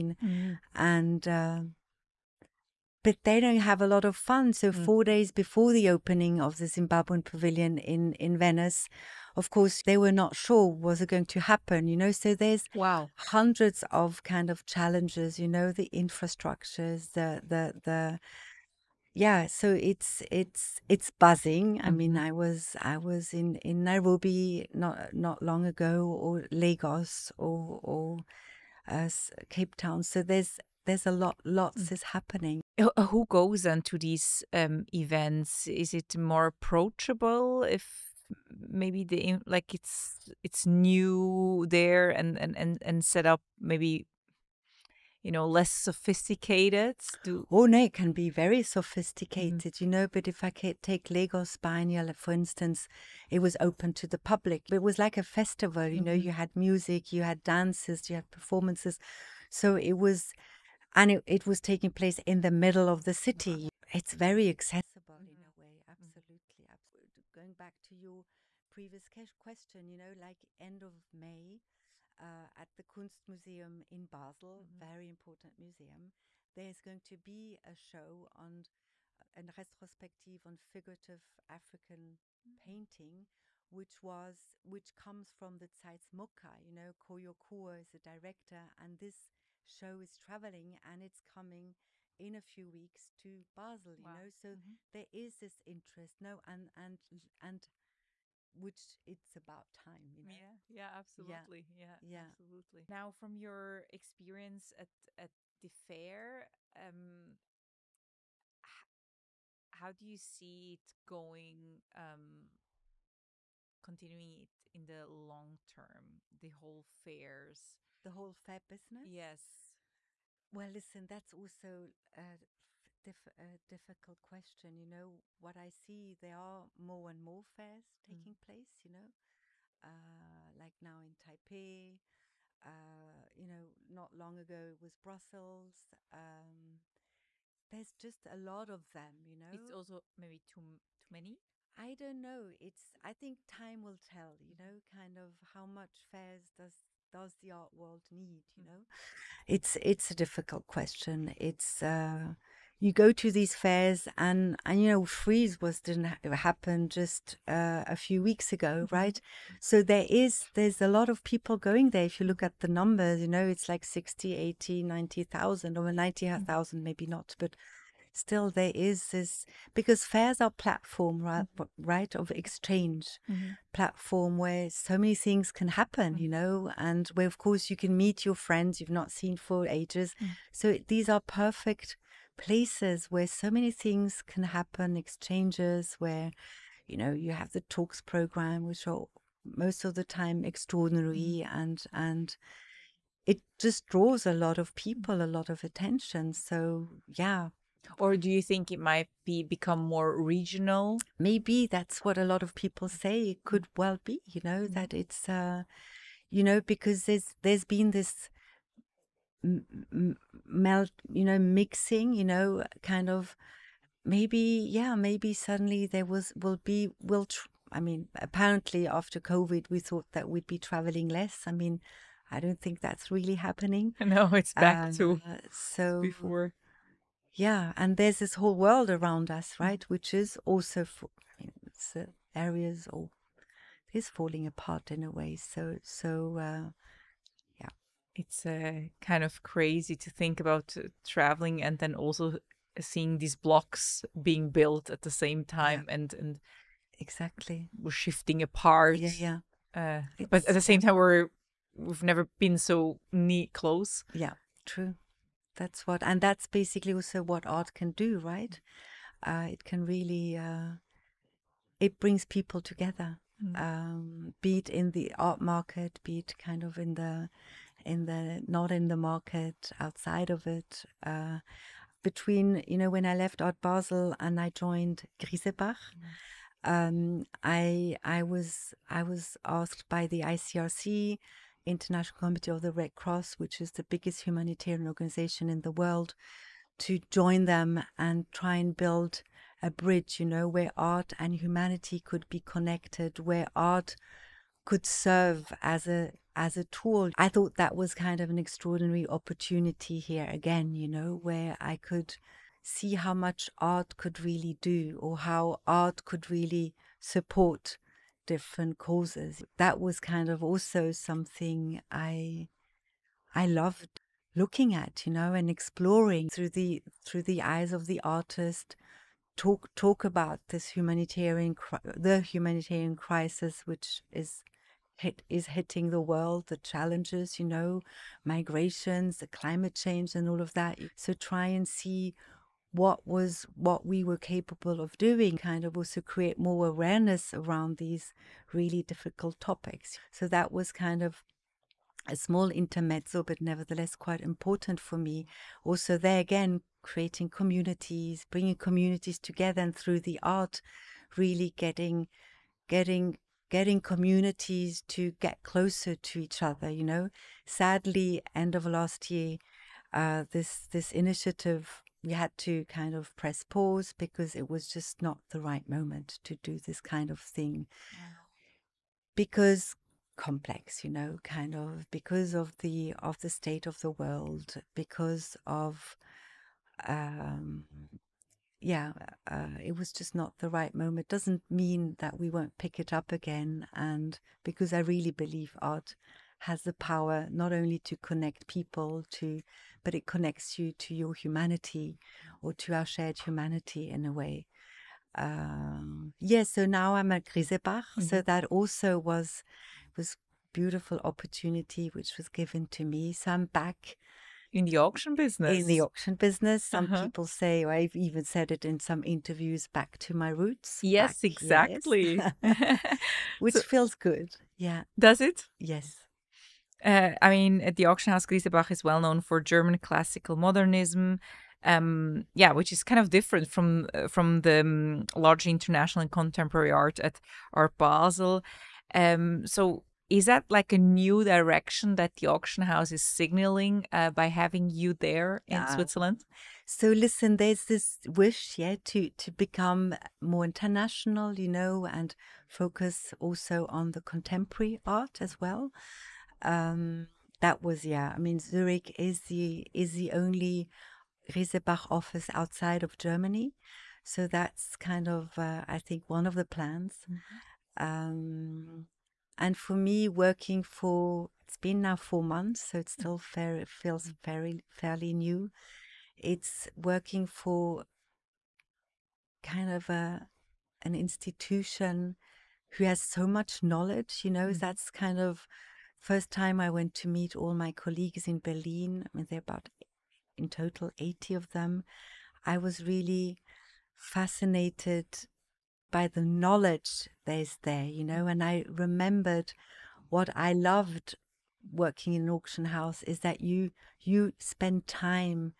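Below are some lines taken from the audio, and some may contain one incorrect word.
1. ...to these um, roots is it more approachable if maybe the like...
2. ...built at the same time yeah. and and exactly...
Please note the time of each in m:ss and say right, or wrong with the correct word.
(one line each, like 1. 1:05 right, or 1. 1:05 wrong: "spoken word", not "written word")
1. 0:33 wrong: "events", not "roots"
2. 4:04 right.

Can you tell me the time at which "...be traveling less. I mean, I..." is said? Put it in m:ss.
3:40.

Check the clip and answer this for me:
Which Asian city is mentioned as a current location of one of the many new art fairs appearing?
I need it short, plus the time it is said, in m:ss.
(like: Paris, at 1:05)
Taipei, at 2:11.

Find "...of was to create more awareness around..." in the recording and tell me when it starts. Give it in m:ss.
5:35.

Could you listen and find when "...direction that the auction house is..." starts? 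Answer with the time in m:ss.
7:11.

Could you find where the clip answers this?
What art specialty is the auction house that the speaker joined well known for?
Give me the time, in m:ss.
6:59.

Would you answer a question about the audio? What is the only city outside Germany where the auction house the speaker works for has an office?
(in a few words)
Zurich.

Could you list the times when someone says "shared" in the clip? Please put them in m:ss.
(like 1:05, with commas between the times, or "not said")
6:32.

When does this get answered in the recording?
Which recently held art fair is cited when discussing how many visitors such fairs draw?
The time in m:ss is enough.
2:35.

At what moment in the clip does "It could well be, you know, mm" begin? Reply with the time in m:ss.
3:23.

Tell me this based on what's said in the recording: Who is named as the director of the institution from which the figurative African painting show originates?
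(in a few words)
Koyo Kouoh.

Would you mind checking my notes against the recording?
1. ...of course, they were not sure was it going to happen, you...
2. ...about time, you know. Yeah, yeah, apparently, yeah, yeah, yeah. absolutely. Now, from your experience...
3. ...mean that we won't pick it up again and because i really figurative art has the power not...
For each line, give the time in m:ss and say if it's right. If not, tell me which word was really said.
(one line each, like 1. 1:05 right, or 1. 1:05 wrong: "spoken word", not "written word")
1. 0:09 right
2. 1:39 wrong: "absolutely", not "apparently"
3. 6:21 wrong: "believe", not "figurative".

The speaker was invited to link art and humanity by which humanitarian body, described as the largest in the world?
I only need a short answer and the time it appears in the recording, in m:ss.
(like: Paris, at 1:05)
ICRC, at 4:40.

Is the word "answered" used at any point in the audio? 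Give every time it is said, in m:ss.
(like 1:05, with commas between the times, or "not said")
not said.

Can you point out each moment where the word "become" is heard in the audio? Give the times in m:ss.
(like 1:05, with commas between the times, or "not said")
3:19, 7:19.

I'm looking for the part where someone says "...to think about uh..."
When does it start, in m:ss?
3:59.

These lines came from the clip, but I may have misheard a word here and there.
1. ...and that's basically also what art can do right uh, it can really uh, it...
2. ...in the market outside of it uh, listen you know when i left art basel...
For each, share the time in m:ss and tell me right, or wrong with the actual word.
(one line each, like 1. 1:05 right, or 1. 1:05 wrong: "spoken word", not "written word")
1. 4:16 right
2. 4:28 wrong: "between", not "listen".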